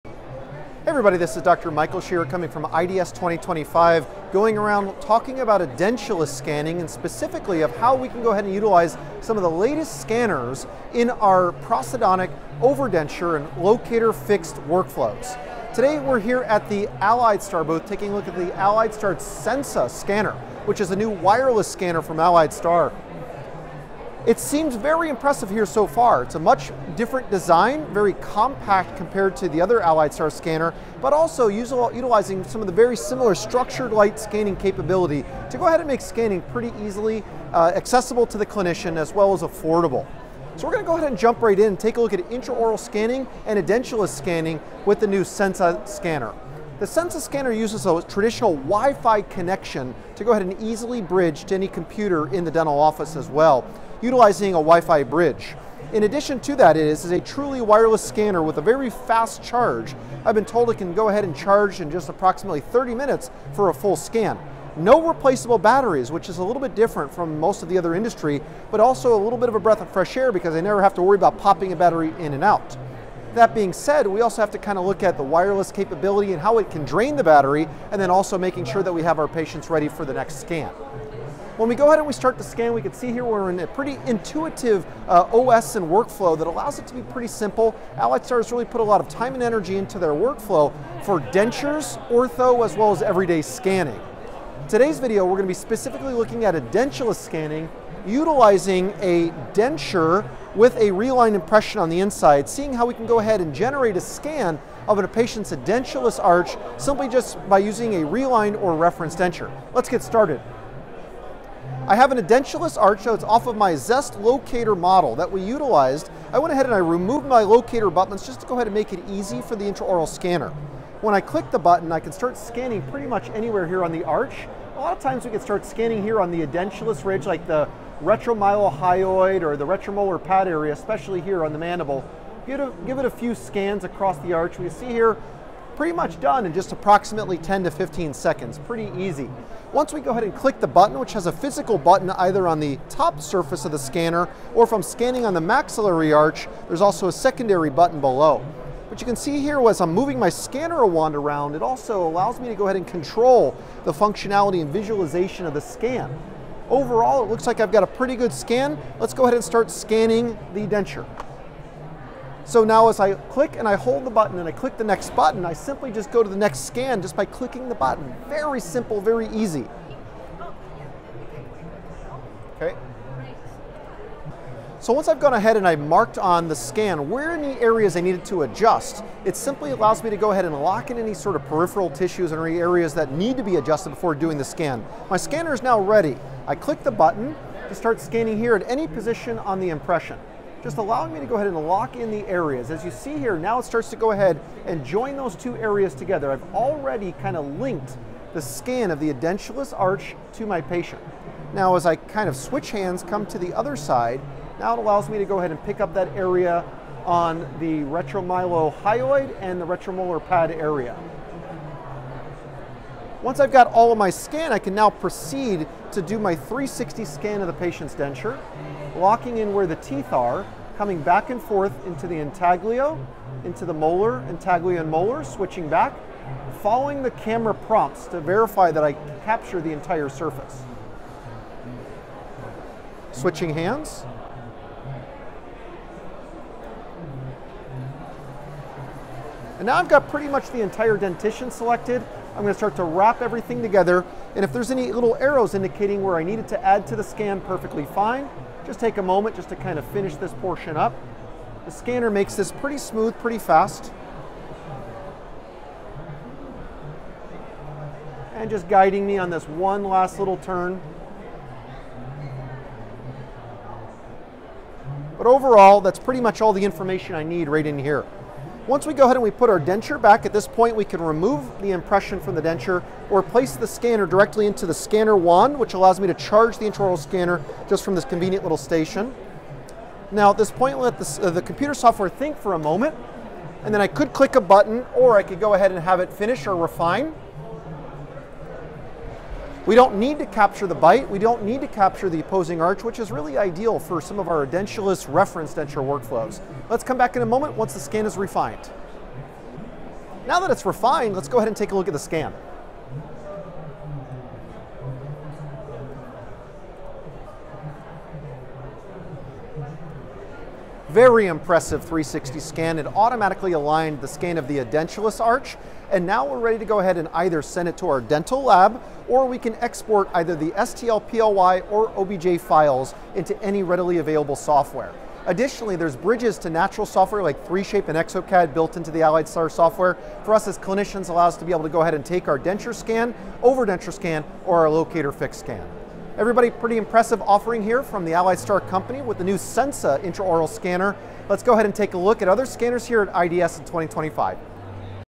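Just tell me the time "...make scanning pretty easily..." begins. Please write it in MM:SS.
00:35.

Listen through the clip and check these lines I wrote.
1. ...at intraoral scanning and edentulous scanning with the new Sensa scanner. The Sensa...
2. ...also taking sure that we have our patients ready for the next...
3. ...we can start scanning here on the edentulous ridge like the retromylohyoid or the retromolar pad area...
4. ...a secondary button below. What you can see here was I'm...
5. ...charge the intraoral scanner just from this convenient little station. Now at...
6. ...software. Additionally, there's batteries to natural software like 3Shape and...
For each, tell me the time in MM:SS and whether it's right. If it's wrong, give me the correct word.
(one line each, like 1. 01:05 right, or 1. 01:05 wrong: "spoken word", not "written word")
1. 00:42 right
2. 01:18 wrong: "making", not "taking"
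3. 02:05 right
4. 02:27 right
5. 04:36 right
6. 05:24 wrong: "bridges", not "batteries".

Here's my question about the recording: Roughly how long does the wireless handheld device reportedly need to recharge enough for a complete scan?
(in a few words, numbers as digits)
30 minutes.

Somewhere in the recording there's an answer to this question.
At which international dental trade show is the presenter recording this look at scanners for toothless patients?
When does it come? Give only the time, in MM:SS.
00:02.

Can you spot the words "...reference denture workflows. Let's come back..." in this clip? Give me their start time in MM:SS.
04:55.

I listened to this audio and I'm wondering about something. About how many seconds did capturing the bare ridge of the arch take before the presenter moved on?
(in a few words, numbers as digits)
10 to 15 seconds.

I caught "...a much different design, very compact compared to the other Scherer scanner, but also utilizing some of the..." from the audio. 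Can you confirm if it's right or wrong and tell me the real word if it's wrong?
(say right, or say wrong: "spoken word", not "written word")
wrong: "Alliedstar", not "Scherer".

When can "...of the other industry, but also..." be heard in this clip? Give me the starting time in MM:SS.
01:07.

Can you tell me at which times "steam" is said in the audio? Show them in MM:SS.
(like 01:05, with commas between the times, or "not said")
not said.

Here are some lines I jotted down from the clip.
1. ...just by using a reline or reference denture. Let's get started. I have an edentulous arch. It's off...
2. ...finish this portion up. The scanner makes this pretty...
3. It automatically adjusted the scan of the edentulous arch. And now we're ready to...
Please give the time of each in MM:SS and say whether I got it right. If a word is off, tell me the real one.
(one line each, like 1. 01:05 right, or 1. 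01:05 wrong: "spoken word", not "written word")
1. 01:47 right
2. 04:09 right
3. 05:12 wrong: "aligned", not "adjusted".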